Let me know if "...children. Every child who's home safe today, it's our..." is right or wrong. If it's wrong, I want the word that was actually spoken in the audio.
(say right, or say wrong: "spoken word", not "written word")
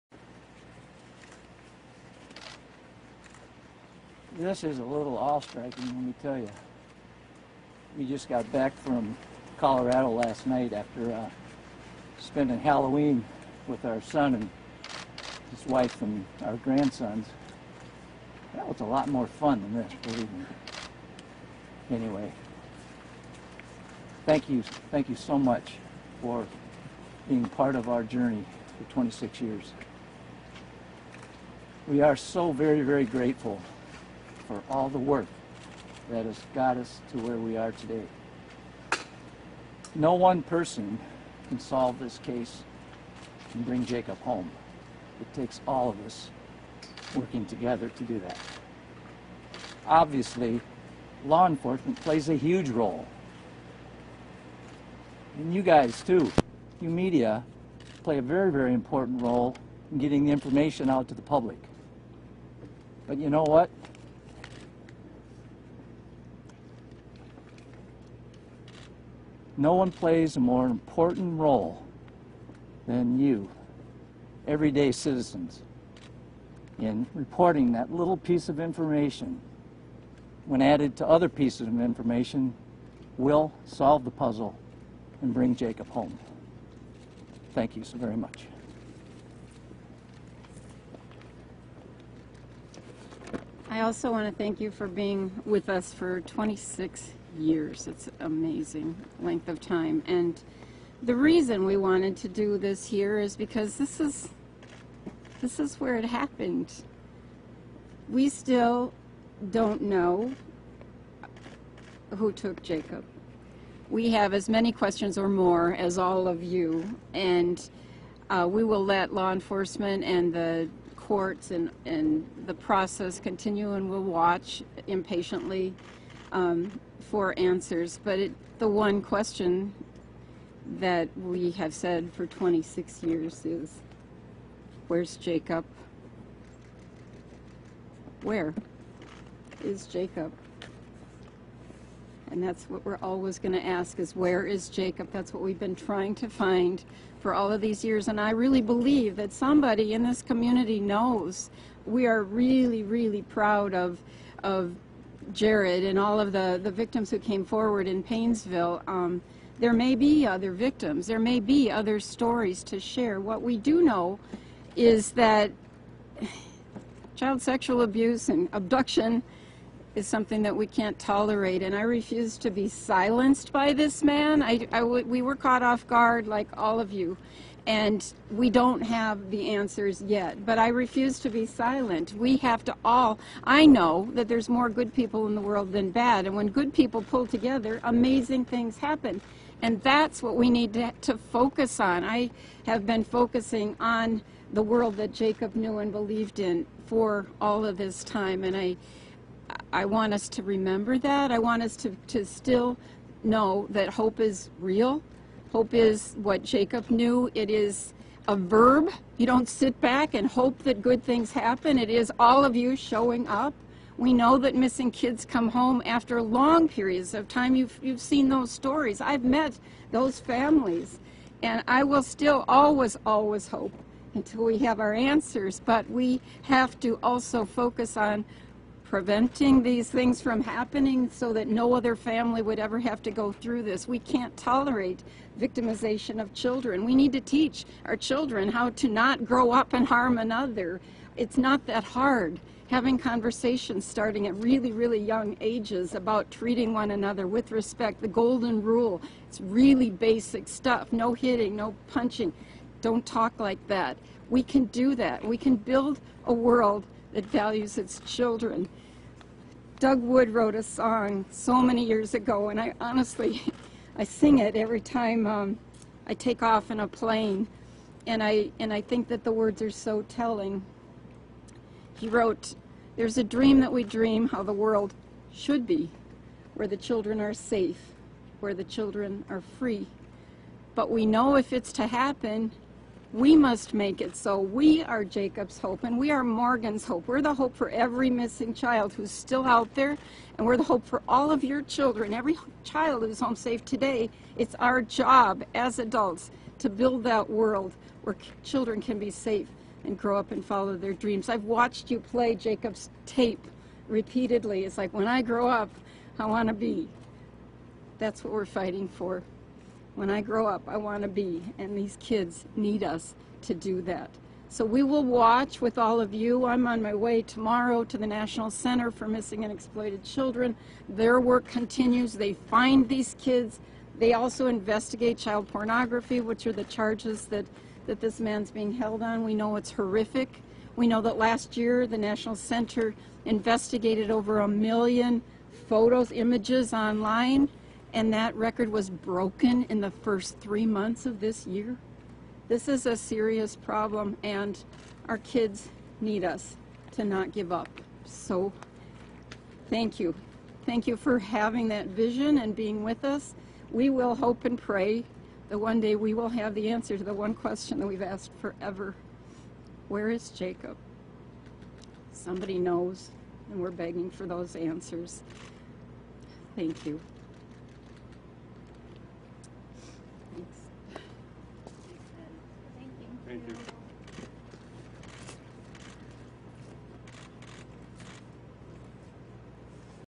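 right.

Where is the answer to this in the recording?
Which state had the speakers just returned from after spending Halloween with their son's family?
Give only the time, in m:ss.
0:09.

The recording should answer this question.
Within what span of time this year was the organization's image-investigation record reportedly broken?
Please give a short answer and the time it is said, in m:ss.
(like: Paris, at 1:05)
first 3 months, at 5:39.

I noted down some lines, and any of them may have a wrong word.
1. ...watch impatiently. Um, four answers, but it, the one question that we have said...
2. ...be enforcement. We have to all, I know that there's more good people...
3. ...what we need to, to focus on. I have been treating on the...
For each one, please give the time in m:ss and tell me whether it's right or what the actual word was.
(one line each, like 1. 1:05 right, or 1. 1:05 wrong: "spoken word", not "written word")
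1. 2:04 right
2. 3:01 wrong: "silent", not "enforcement"
3. 3:10 wrong: "focusing", not "treating".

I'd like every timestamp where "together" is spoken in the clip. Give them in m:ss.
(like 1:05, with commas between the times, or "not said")
0:47, 3:07.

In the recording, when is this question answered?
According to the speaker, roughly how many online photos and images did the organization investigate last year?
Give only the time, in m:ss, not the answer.
5:34.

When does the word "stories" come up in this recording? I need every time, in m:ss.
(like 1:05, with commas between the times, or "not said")
2:41, 3:38.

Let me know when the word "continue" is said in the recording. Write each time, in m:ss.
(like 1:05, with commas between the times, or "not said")
2:03, 5:21.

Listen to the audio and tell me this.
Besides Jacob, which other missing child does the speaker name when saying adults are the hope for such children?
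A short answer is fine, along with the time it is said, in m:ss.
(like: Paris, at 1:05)
Morgan, at 4:46.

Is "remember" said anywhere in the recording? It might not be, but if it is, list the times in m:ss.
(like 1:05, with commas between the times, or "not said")
3:20.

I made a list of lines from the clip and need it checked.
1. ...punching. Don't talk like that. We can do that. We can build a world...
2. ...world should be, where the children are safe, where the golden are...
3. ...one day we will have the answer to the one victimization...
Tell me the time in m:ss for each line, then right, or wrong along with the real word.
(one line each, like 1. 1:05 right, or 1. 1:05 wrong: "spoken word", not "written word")
1. 4:11 right
2. 4:34 wrong: "children", not "golden"
3. 5:55 wrong: "question", not "victimization".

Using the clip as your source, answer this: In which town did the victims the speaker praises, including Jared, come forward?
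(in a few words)
Paynesville.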